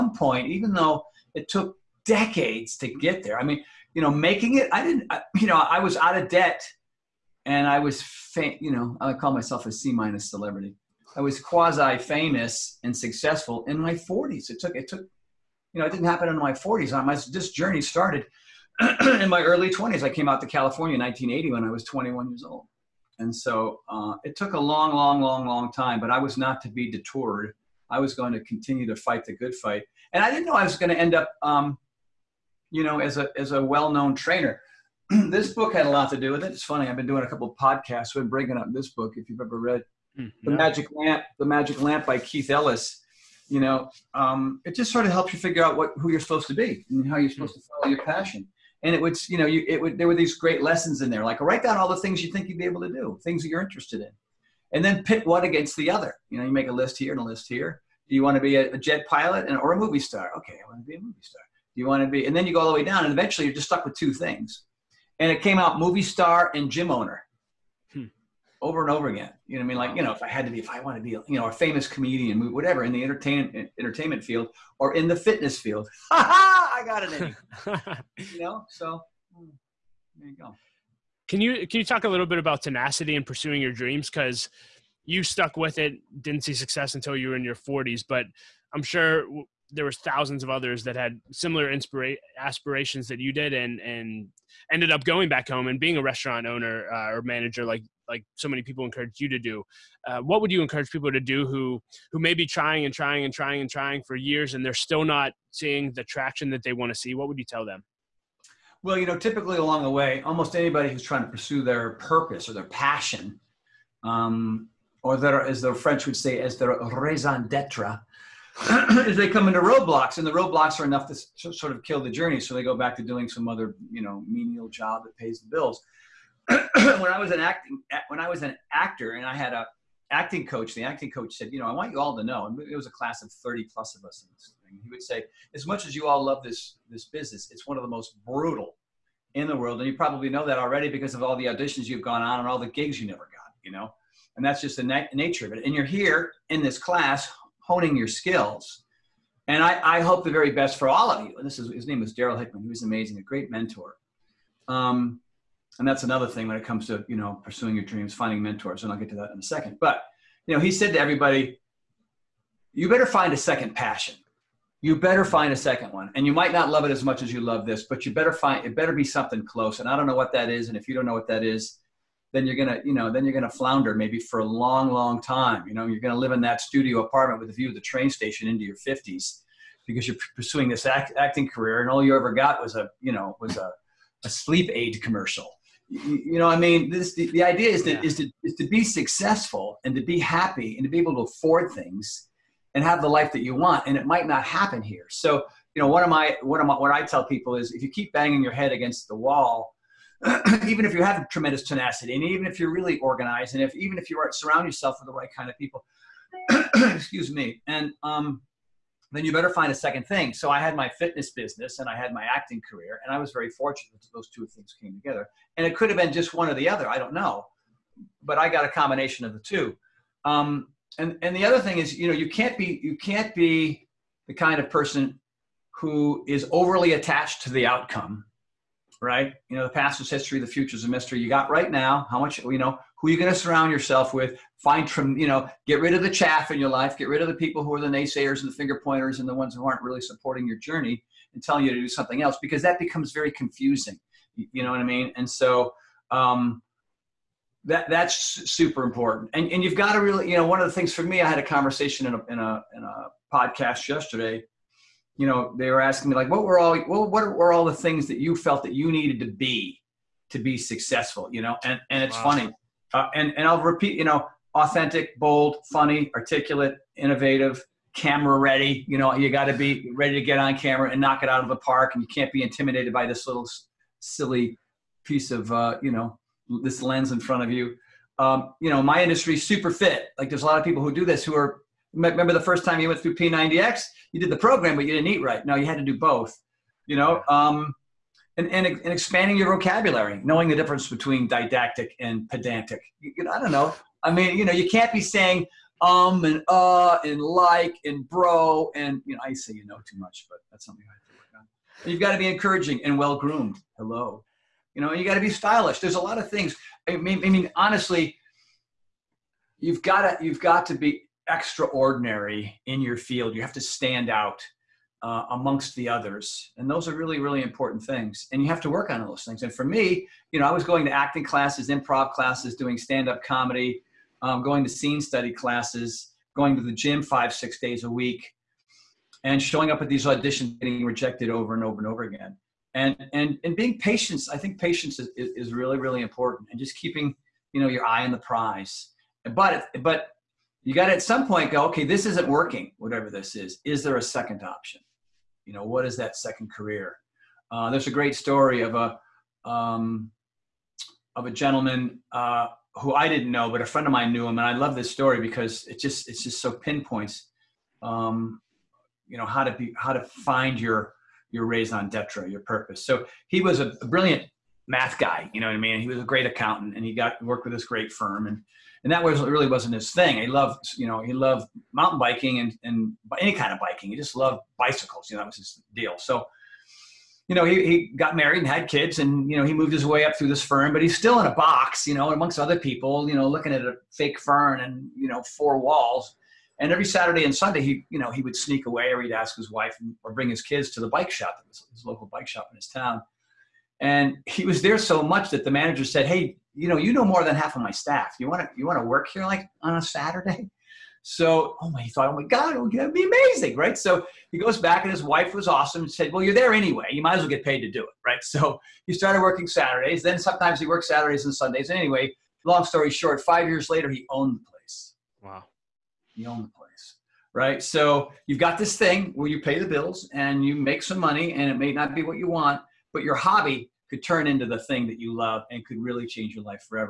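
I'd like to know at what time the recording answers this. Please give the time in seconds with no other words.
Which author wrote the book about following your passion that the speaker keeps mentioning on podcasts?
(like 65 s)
42 s.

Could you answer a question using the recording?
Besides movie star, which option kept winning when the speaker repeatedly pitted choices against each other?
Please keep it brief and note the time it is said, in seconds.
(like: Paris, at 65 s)
gym owner, at 66 s.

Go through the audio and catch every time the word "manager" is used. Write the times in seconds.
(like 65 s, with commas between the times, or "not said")
97 s, 395 s.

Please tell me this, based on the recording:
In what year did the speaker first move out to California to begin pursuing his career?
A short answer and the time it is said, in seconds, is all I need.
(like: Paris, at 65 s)
1980, at 21 s.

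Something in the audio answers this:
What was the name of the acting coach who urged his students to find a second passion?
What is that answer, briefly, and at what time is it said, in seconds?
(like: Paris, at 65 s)
Darryl Hickman, at 152 s.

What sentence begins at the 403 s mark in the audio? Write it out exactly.
So he goes back, and his wife was awesome and said, Well, you're there anyway.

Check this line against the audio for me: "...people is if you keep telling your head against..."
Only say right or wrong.
wrong.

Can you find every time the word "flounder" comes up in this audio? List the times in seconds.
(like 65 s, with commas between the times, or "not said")
173 s.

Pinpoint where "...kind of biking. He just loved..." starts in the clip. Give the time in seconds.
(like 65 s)
373 s.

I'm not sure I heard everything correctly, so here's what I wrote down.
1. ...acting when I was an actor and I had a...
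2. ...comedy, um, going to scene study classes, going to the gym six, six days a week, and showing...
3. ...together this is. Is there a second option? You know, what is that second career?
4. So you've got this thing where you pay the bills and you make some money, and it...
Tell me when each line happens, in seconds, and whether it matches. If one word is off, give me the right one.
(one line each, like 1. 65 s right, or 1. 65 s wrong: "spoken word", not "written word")
1. 127 s right
2. 323 s wrong: "five", not "six"
3. 342 s wrong: "whatever", not "together"
4. 417 s right.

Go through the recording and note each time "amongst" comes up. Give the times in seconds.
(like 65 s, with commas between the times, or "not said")
315 s, 382 s.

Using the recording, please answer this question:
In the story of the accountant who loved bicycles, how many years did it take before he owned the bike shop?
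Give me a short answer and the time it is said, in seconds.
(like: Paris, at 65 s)
5, at 413 s.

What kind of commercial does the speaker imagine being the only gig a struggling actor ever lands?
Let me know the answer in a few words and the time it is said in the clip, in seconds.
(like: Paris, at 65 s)
sleep aid, at 184 s.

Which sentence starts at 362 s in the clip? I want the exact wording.
So he was a brilliant math guy, you know what I mean?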